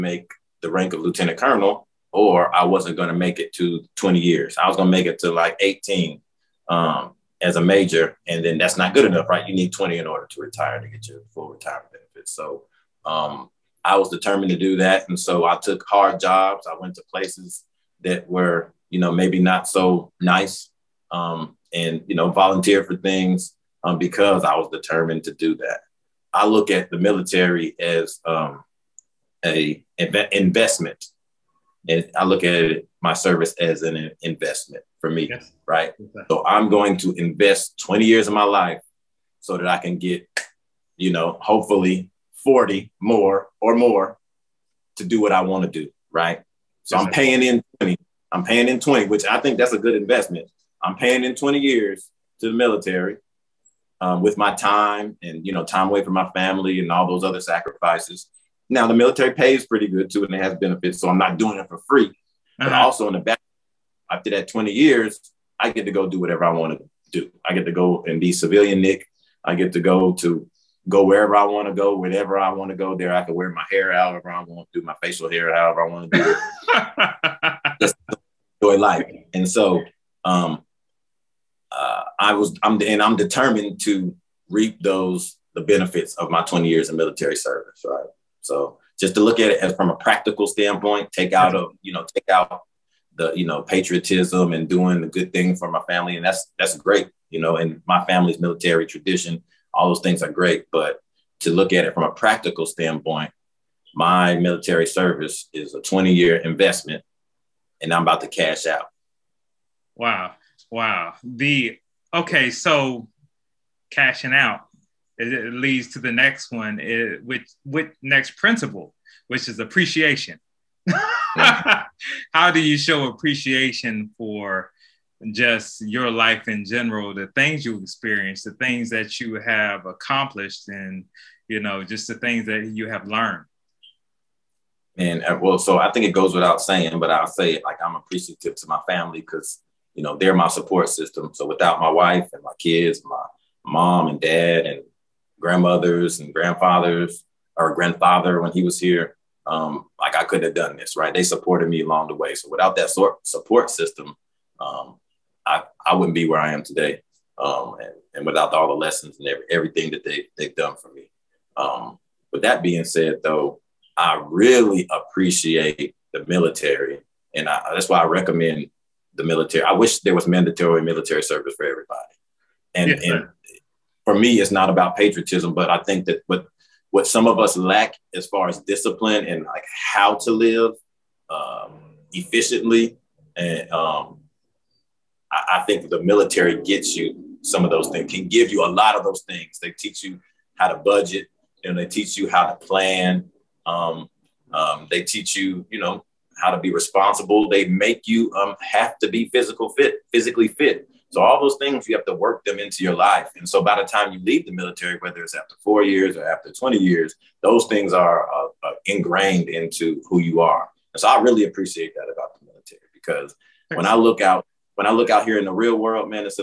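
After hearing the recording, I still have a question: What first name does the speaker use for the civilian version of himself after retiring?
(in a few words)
Nic.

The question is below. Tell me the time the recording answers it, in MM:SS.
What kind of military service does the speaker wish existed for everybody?
02:50.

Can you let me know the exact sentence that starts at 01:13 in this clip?
I can wear my hair however I want, do my facial hair however I want to do it.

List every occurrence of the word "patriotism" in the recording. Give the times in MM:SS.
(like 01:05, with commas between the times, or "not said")
01:33, 02:54.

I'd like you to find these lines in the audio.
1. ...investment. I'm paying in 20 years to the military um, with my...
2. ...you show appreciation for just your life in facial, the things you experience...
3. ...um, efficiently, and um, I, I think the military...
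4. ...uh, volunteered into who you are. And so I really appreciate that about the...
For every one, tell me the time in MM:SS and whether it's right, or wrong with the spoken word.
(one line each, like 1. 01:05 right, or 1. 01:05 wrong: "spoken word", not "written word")
1. 00:49 right
2. 02:02 wrong: "general", not "facial"
3. 03:01 right
4. 03:28 wrong: "ingrained", not "volunteered".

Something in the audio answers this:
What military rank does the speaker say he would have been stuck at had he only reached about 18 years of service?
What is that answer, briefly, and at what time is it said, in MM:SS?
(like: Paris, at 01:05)
Major, at 00:07.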